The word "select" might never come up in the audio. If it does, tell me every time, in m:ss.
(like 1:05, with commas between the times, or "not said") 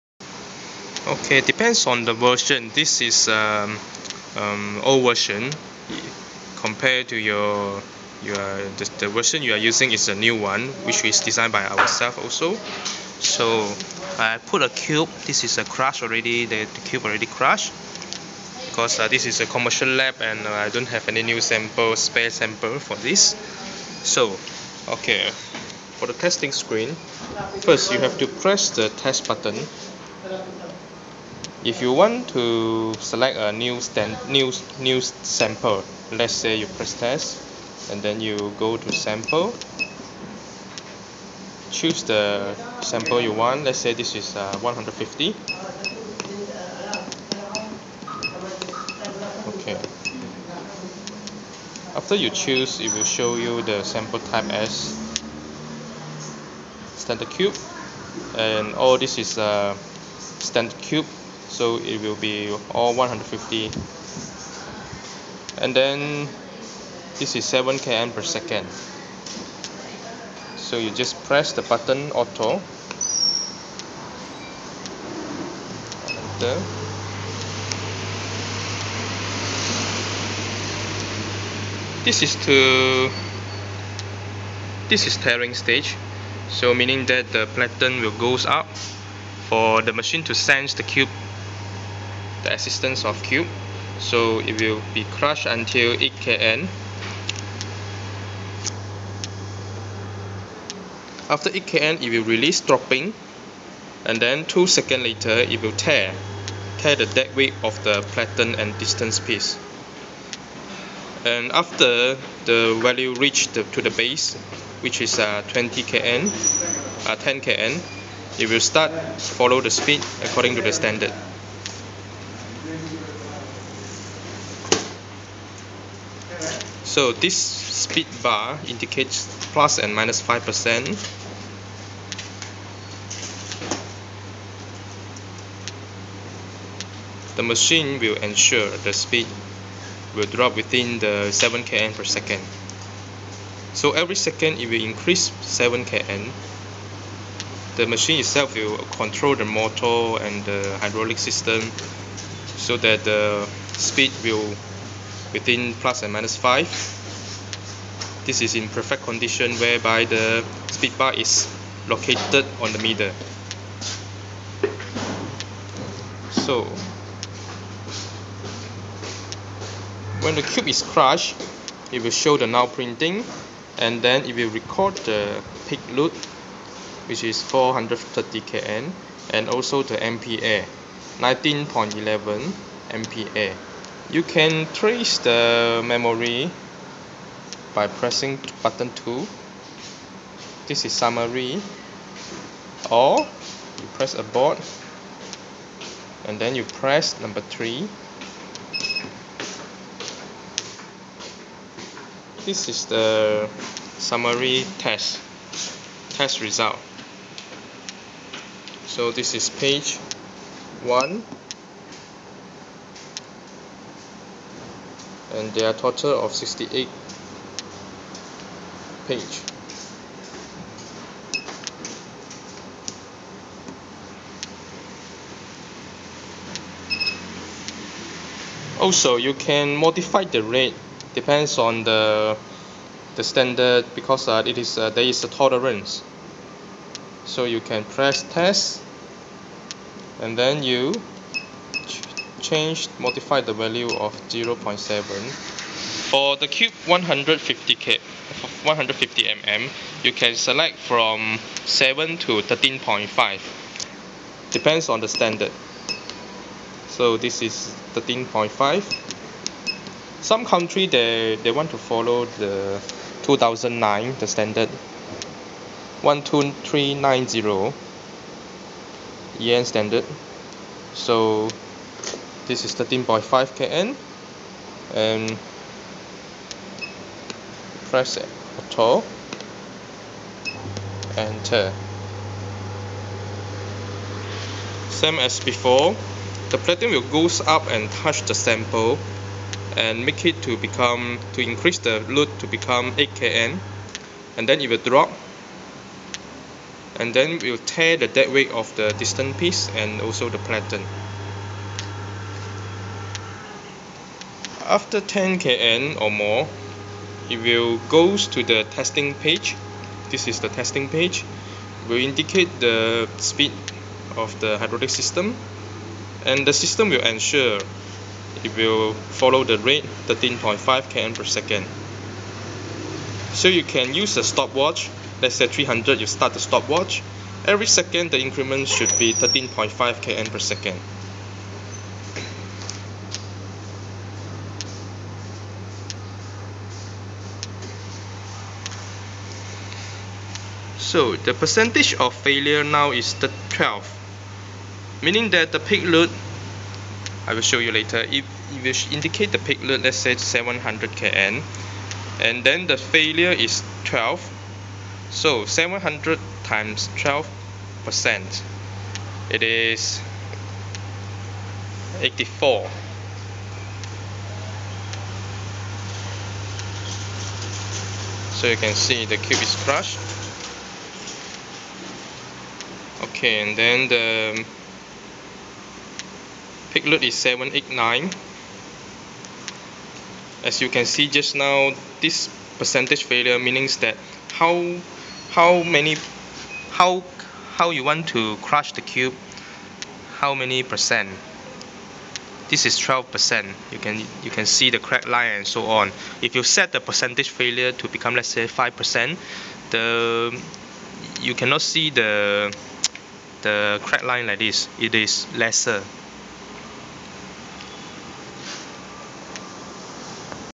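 0:32, 4:10.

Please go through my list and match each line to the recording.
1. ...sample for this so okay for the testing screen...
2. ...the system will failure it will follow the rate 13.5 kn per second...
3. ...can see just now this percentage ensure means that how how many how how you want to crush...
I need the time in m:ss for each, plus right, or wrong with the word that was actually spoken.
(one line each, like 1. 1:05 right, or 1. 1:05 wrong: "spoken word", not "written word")
1. 0:22 right
2. 5:16 wrong: "ensure", not "failure"
3. 6:20 wrong: "failure", not "ensure".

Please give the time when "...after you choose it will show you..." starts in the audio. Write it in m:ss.
0:51.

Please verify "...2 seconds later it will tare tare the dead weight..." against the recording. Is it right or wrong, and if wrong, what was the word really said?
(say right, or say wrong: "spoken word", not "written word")
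right.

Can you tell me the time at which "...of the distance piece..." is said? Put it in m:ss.
4:58.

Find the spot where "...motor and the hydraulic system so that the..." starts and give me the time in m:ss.
2:29.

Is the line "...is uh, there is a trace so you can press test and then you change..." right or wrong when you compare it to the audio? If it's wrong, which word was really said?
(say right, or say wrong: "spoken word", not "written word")
wrong: "tolerance", not "trace".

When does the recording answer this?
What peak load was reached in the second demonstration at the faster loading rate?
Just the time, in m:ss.
6:17.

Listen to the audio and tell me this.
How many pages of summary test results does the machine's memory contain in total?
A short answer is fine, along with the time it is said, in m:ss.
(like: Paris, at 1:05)
68, at 3:36.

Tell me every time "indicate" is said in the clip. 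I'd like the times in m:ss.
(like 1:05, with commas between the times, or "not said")
2:08, 5:12, 5:48.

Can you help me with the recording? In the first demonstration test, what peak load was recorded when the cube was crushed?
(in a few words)
430 kN.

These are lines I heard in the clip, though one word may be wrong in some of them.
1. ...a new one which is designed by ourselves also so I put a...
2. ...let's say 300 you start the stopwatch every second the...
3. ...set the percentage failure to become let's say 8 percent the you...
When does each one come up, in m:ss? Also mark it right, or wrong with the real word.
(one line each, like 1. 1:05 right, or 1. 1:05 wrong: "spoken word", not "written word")
1. 0:10 right
2. 5:25 right
3. 6:36 wrong: "5", not "8".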